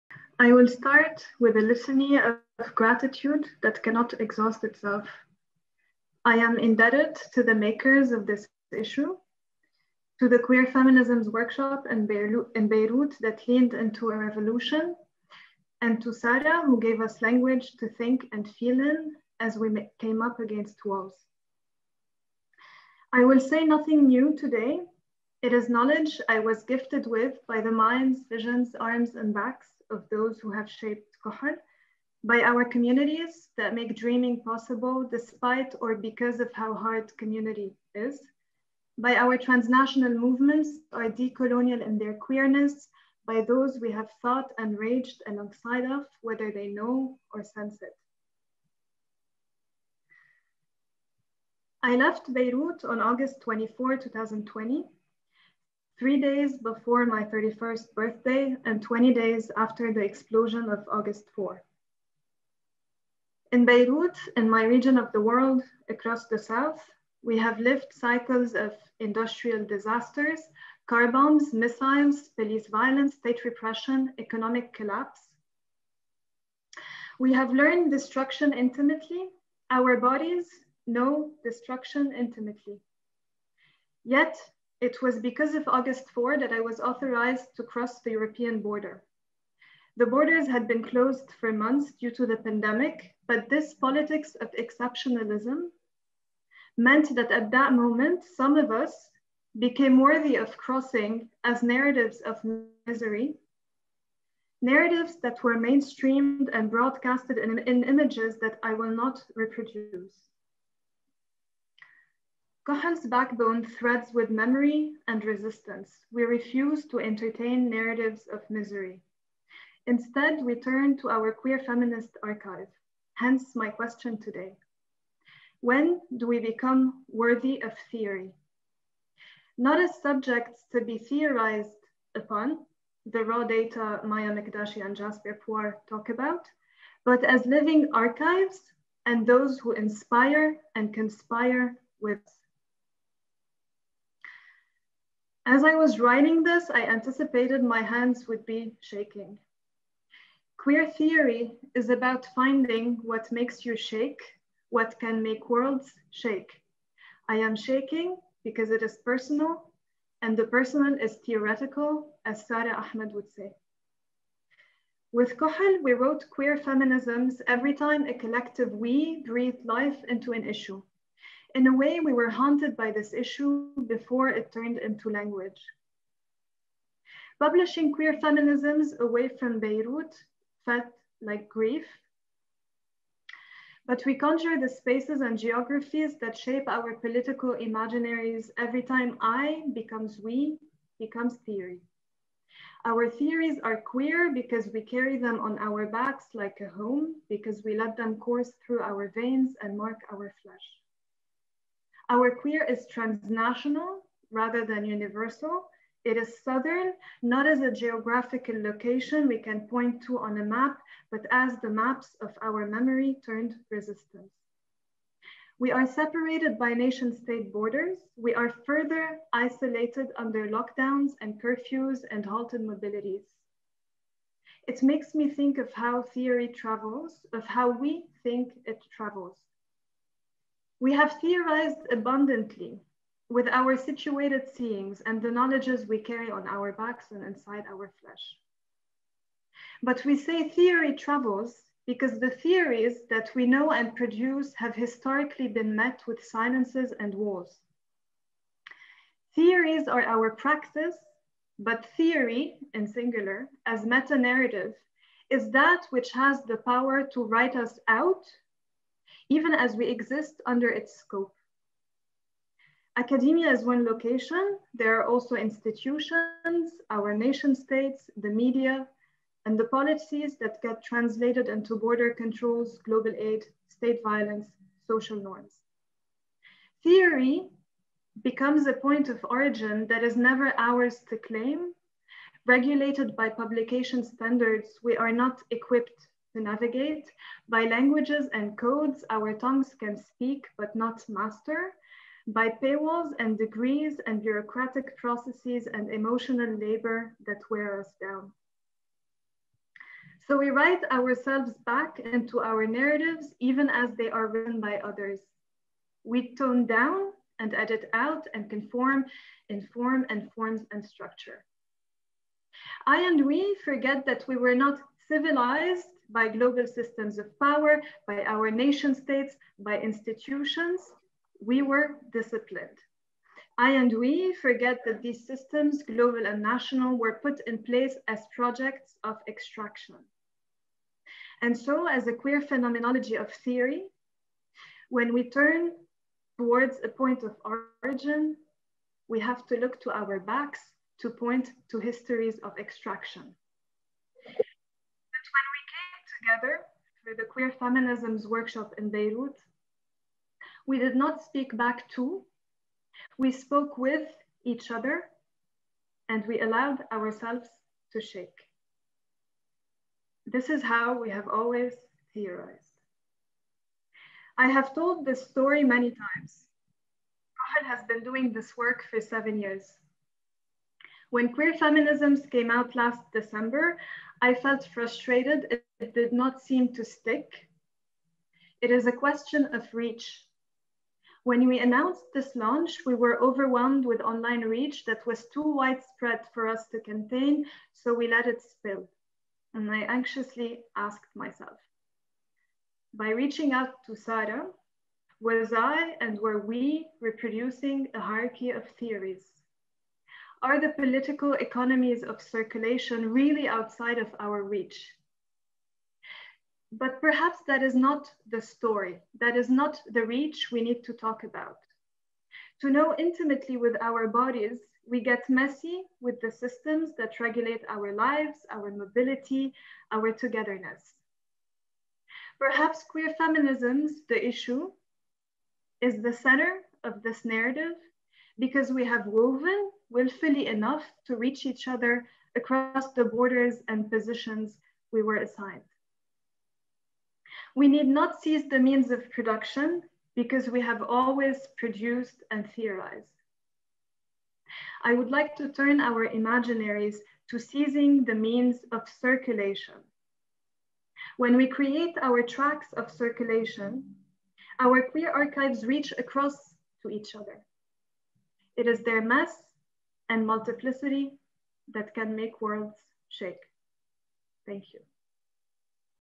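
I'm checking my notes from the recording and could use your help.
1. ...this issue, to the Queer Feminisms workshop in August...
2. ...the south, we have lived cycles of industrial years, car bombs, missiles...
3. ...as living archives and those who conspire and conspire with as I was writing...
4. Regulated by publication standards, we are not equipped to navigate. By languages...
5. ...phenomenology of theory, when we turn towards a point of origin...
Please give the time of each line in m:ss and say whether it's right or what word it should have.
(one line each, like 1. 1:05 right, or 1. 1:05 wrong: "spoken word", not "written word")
1. 0:08 wrong: "Beirut", not "August"
2. 1:06 wrong: "disasters", not "years"
3. 2:17 wrong: "inspire", not "conspire"
4. 4:42 right
5. 5:32 right.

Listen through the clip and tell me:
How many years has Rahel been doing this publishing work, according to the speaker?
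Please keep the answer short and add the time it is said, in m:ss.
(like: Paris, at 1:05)
7, at 6:09.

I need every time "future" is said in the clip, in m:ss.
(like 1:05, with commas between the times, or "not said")
not said.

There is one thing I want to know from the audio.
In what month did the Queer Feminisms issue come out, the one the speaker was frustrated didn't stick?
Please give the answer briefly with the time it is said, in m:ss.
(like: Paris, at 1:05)
December, at 6:13.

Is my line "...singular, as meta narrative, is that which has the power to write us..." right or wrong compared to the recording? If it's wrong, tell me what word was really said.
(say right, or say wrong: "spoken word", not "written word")
right.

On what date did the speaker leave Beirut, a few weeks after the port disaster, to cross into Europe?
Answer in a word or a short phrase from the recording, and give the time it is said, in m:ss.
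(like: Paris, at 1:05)
August 24, 2020, at 0:53.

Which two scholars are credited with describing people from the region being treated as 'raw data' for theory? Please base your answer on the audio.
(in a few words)
Maya Mikdashi and Jasbir Puar.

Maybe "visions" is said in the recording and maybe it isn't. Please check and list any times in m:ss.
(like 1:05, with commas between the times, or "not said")
0:28.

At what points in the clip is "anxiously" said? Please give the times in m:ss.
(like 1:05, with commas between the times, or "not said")
6:29.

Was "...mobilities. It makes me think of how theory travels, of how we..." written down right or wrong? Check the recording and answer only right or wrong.
right.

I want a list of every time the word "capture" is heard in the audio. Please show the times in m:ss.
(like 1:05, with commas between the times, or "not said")
not said.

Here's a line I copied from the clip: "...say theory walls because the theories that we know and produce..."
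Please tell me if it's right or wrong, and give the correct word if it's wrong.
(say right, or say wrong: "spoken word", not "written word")
wrong: "travels", not "walls".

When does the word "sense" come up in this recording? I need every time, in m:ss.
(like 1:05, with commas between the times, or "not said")
0:47.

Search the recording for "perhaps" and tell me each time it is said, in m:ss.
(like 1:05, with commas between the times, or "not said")
6:47, 7:02.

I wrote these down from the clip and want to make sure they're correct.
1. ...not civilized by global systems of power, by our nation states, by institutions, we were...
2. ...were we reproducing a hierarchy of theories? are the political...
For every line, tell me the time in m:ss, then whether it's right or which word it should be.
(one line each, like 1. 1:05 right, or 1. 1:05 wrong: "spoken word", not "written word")
1. 5:14 right
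2. 6:36 right.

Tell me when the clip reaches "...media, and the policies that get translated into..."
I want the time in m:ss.
4:28.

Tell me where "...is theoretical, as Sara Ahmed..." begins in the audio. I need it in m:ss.
2:40.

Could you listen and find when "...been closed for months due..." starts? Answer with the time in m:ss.
1:30.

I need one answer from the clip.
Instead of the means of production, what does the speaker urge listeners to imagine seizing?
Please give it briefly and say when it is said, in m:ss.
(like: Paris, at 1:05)
the means of circulation, at 7:28.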